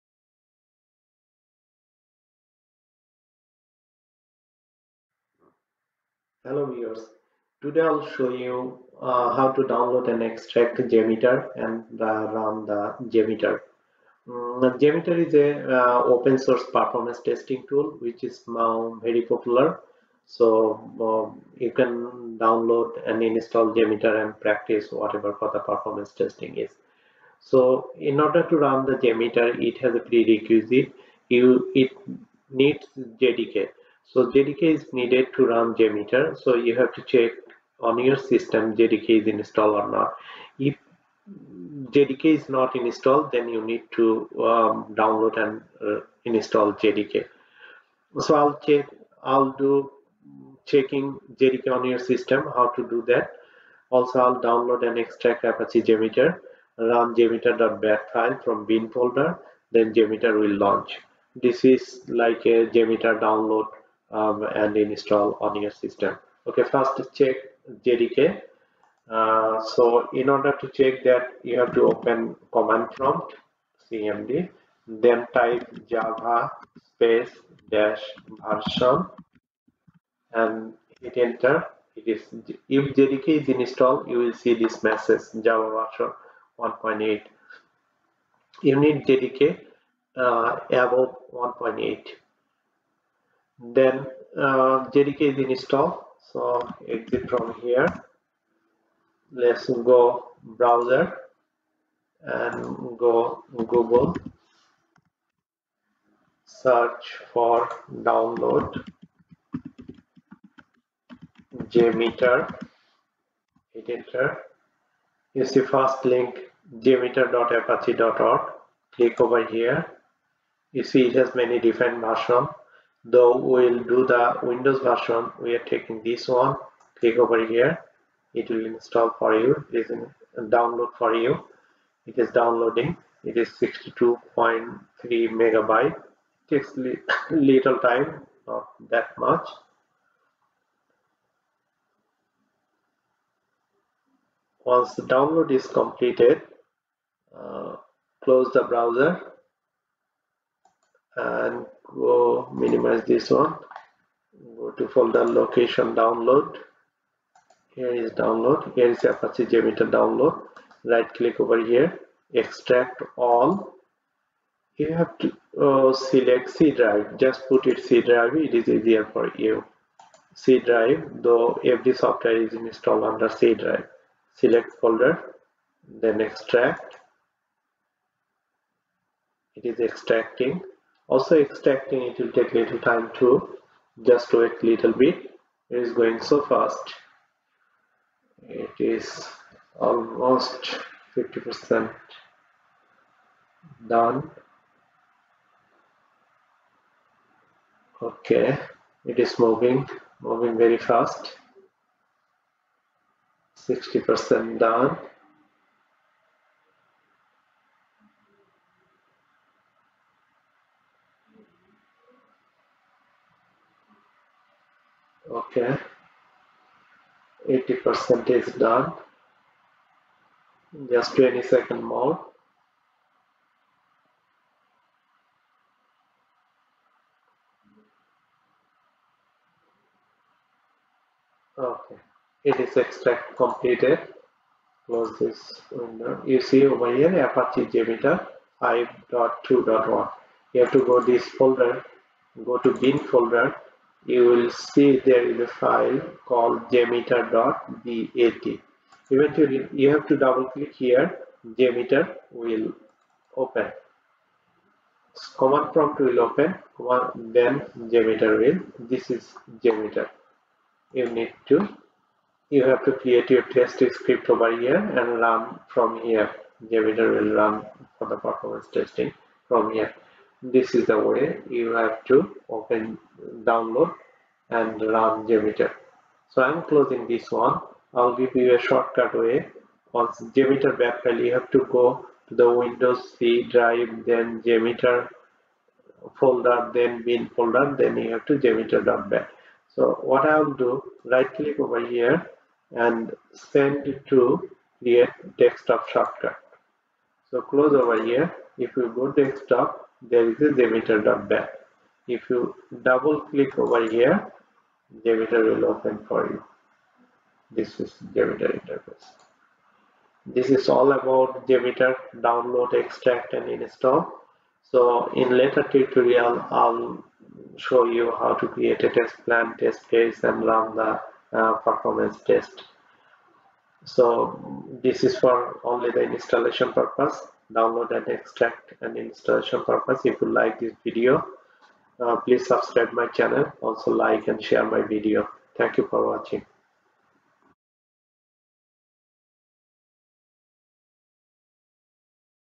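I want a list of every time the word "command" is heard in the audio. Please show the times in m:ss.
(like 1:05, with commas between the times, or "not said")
1:12, 4:15.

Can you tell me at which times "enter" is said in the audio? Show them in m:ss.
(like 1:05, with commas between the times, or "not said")
1:21, 1:53.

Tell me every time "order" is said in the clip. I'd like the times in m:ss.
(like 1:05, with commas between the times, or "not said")
0:28, 1:10.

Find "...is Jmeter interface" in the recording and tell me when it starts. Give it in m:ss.
5:07.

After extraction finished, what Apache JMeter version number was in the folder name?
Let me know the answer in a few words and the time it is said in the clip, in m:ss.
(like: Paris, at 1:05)
5.2.1, at 3:58.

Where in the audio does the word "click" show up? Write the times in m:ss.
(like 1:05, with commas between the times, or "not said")
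1:58, 2:06, 2:41, 4:10, 4:51, 5:03.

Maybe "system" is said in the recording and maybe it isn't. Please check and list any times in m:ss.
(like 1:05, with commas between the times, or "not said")
0:38, 0:51, 1:05.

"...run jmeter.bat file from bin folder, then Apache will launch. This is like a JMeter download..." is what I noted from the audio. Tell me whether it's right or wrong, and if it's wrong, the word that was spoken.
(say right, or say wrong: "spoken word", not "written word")
wrong: "JMeter", not "Apache".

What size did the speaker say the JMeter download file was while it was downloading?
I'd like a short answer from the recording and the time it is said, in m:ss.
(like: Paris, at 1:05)
62.3 megabytes, at 2:13.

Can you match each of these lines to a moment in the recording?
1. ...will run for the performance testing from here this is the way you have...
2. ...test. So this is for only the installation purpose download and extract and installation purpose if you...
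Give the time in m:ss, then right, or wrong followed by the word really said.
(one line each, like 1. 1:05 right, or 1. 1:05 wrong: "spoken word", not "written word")
1. 4:27 right
2. 5:22 right.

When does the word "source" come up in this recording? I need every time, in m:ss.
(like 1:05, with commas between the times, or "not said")
0:16.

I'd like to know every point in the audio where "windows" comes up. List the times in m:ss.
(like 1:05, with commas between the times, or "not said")
2:04, 3:55, 4:42.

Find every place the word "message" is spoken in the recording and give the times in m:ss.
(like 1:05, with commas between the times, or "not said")
1:24.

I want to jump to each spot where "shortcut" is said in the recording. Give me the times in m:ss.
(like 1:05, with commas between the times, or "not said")
4:38, 4:55.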